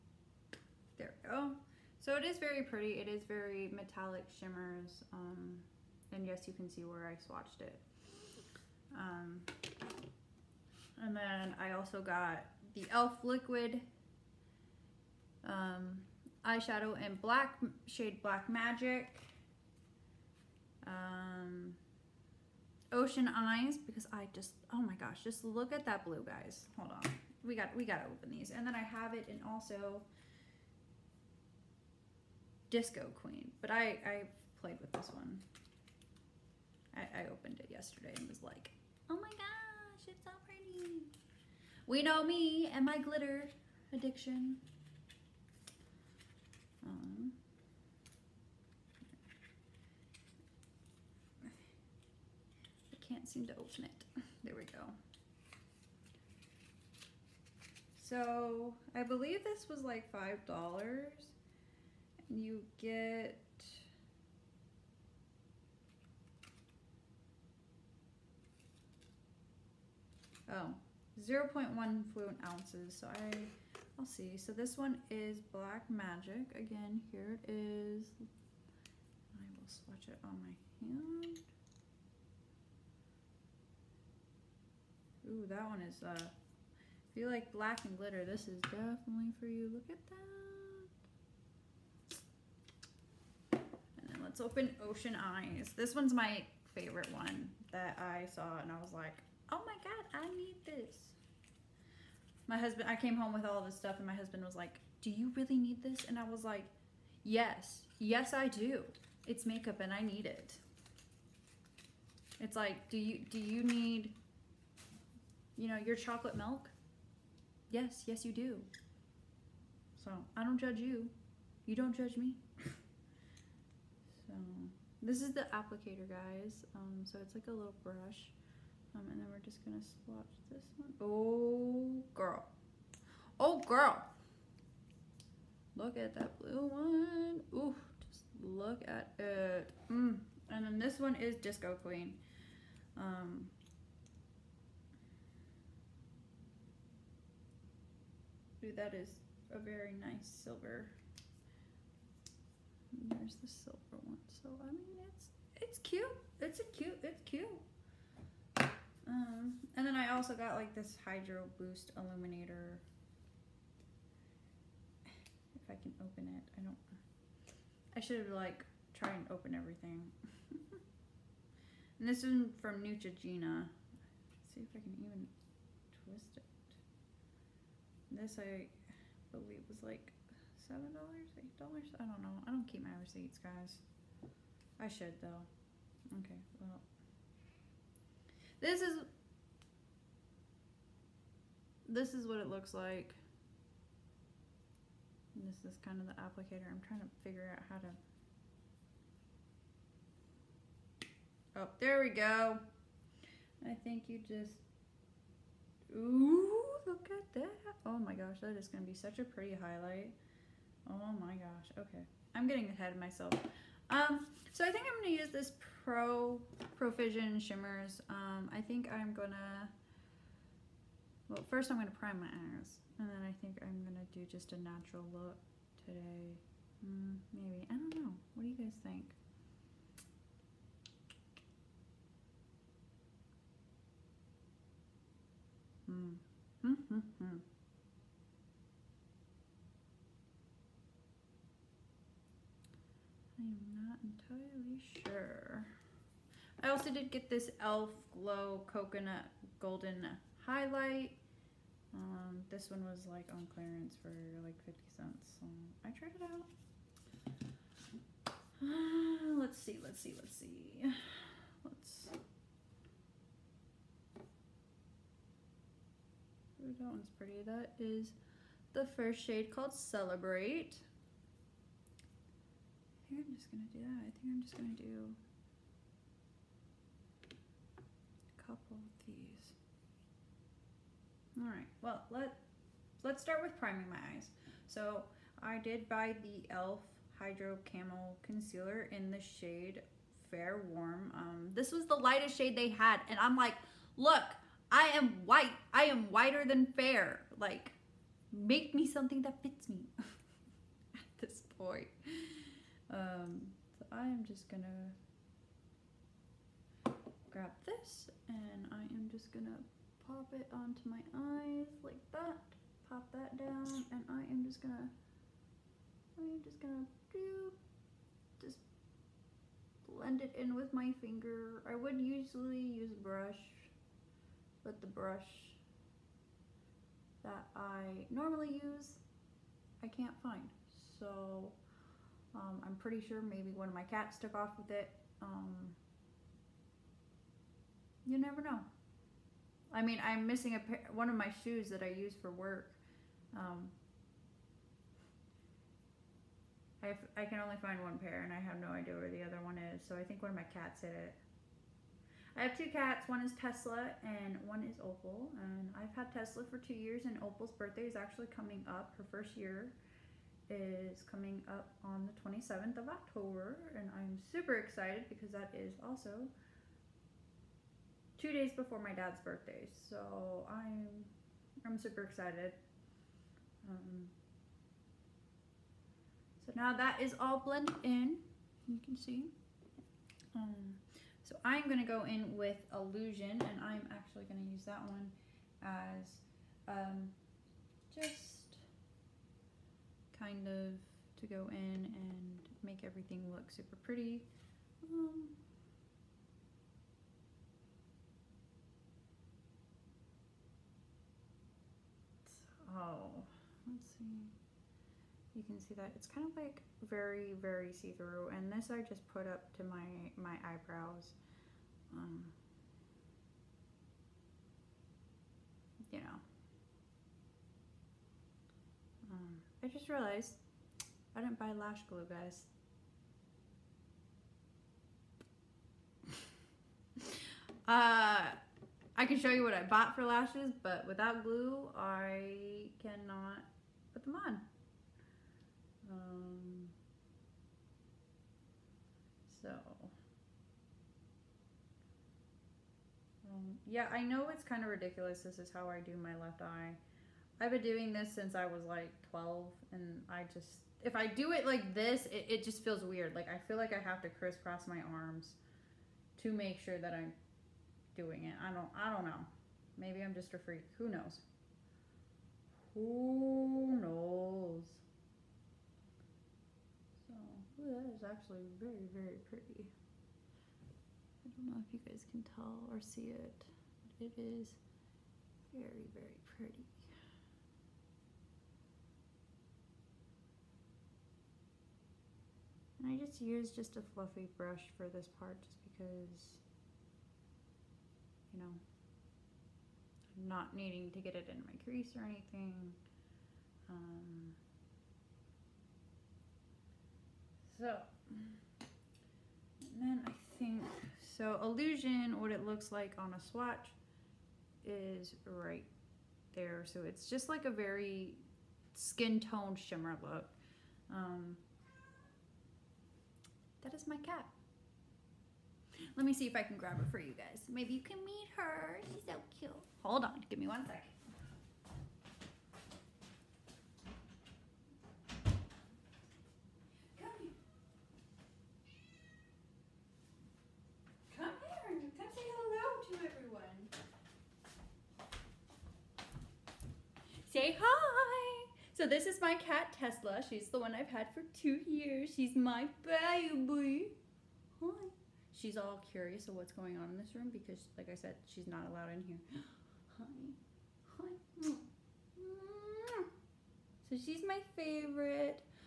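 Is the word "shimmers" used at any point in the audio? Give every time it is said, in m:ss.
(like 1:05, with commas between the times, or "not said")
0:04, 3:37, 8:29.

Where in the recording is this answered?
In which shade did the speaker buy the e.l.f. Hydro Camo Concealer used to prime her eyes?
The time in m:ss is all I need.
4:50.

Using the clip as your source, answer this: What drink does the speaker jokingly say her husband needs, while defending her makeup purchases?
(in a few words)
chocolate milk.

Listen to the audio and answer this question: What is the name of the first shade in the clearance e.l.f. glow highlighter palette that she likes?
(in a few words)
Celebrate.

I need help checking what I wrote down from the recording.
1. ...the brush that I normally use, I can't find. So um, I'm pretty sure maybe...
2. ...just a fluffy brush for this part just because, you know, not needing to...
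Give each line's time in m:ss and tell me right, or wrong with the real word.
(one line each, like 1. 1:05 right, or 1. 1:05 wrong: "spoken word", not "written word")
1. 5:24 right
2. 8:03 right.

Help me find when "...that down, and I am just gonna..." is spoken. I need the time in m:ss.
5:13.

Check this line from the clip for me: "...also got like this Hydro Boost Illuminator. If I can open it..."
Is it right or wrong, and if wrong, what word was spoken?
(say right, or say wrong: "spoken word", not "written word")
right.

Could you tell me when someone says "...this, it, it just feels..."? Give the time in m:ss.
7:31.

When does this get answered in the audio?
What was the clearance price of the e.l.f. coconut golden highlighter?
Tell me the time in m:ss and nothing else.
4:14.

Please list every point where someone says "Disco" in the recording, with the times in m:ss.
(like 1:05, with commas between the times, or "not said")
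0:32, 2:21.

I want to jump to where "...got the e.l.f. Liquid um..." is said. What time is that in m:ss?
0:12.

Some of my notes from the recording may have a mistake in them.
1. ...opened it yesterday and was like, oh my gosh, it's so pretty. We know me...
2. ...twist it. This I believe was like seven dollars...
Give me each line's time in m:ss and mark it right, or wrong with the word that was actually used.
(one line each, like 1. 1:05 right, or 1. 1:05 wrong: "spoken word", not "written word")
1. 0:37 right
2. 2:56 right.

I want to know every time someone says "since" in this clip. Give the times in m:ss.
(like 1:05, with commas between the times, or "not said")
7:28.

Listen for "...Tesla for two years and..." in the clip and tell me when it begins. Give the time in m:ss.
5:56.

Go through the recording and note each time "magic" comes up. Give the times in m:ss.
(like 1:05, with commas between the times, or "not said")
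0:18, 1:15.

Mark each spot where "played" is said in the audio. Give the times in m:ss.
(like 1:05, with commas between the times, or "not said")
0:34.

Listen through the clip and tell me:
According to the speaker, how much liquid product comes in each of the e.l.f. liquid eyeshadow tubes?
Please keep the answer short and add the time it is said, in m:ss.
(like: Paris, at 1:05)
0.1 fluid ounces, at 1:11.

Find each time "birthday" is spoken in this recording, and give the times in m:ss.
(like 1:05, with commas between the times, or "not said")
5:57, 6:09.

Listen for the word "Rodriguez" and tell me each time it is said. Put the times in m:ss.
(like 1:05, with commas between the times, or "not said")
not said.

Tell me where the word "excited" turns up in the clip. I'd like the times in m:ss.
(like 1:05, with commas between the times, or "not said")
6:04, 6:12.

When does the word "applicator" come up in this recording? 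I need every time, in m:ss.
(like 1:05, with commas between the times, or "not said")
2:05, 3:16.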